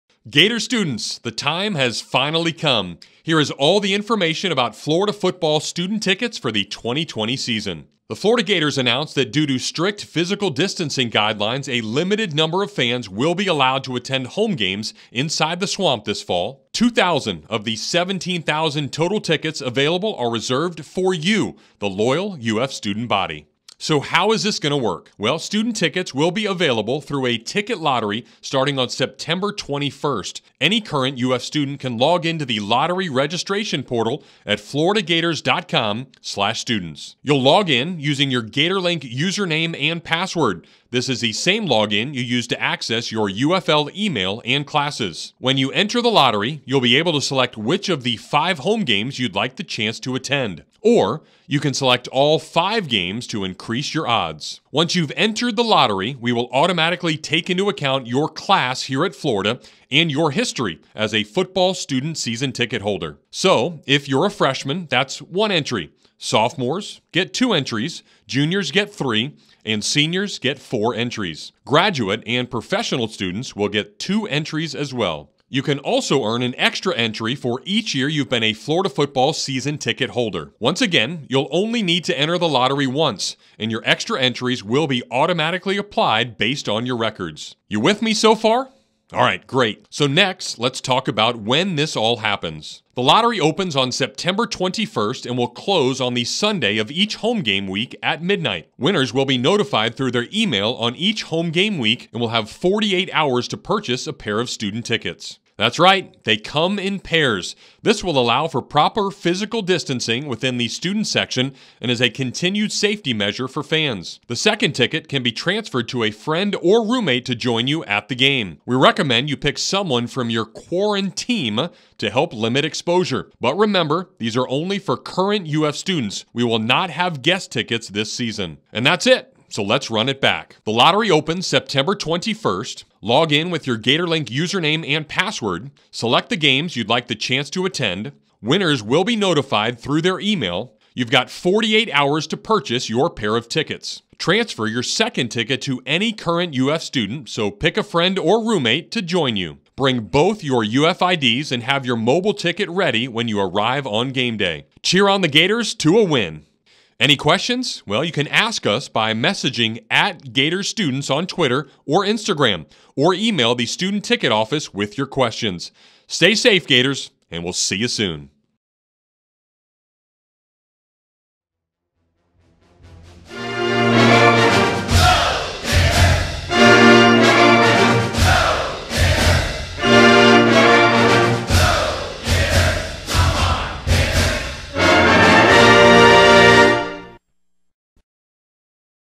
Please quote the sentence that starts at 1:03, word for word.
So, if you're a freshman, that's one entry.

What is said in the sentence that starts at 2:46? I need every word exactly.
Stay safe, Gators, and we'll see you soon.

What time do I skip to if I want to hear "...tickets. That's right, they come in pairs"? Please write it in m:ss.
1:44.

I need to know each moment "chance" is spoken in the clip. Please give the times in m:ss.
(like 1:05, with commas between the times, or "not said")
0:49, 2:17.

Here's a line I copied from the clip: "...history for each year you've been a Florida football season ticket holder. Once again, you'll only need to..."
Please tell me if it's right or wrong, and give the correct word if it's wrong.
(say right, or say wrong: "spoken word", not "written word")
wrong: "entry", not "history".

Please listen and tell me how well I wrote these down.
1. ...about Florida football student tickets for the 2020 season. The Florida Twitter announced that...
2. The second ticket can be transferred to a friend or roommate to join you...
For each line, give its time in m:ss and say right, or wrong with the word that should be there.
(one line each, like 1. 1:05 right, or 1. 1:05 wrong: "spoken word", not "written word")
1. 0:04 wrong: "Gators", not "Twitter"
2. 1:54 right.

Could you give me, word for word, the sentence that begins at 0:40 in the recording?
This is the same login you use to access your UFL email and classes.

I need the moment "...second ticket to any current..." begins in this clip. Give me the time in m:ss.
2:24.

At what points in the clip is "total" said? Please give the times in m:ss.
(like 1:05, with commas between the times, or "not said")
0:18.